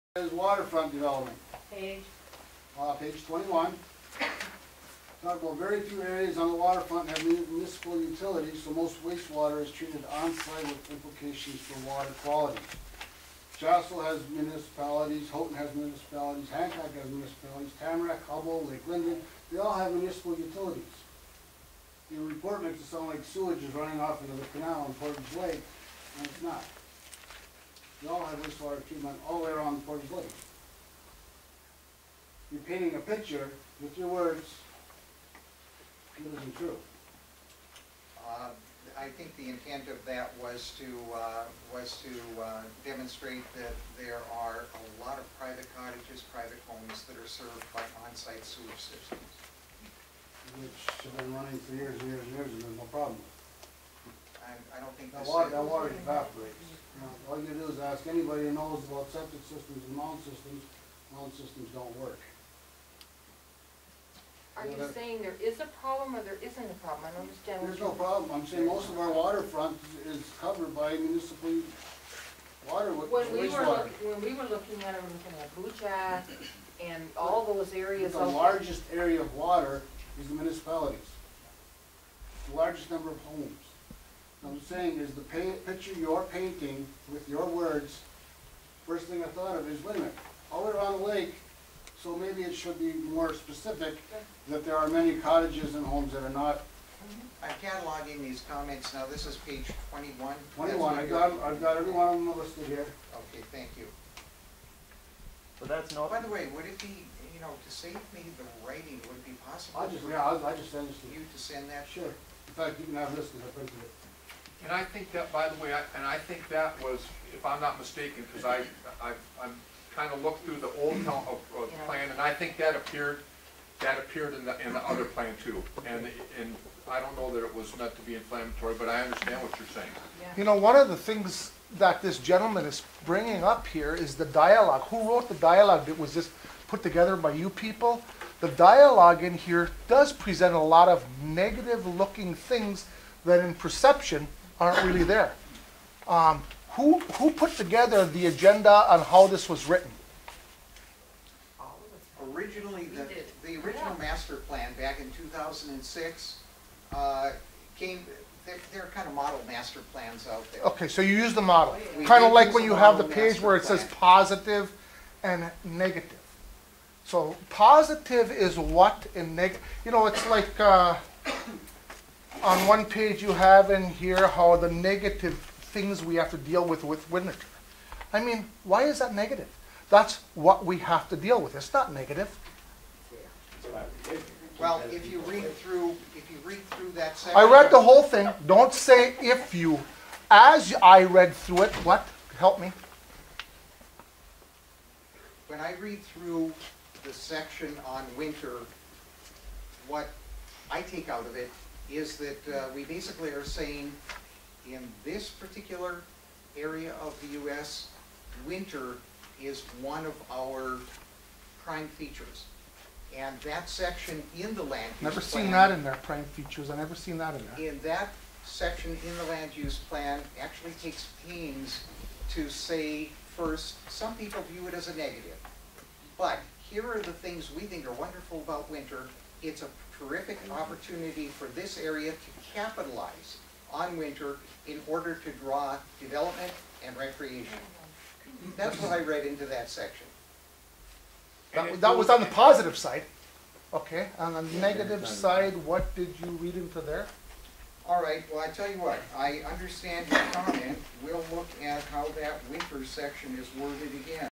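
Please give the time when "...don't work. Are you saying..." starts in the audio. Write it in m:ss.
1:01.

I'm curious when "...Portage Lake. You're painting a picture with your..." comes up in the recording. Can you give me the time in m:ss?
0:29.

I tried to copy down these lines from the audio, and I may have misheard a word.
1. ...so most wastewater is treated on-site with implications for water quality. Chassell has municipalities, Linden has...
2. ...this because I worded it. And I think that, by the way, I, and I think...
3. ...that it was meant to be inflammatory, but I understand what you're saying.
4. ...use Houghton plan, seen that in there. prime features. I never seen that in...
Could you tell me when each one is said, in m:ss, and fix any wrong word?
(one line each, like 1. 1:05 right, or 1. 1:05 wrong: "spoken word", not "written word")
1. 0:08 wrong: "Houghton", not "Linden"
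2. 1:53 wrong: "printed", not "worded"
3. 2:07 right
4. 3:35 wrong: "Never", not "Houghton".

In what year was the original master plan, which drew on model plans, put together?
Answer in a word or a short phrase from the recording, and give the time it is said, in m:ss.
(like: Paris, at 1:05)
2006, at 2:35.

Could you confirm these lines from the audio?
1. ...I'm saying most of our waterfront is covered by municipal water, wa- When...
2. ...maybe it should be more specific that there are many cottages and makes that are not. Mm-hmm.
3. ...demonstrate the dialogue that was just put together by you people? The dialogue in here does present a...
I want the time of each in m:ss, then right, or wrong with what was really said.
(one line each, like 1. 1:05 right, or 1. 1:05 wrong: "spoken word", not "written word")
1. 1:08 right
2. 1:32 wrong: "homes", not "makes"
3. 2:15 wrong: "wrote", not "demonstrate".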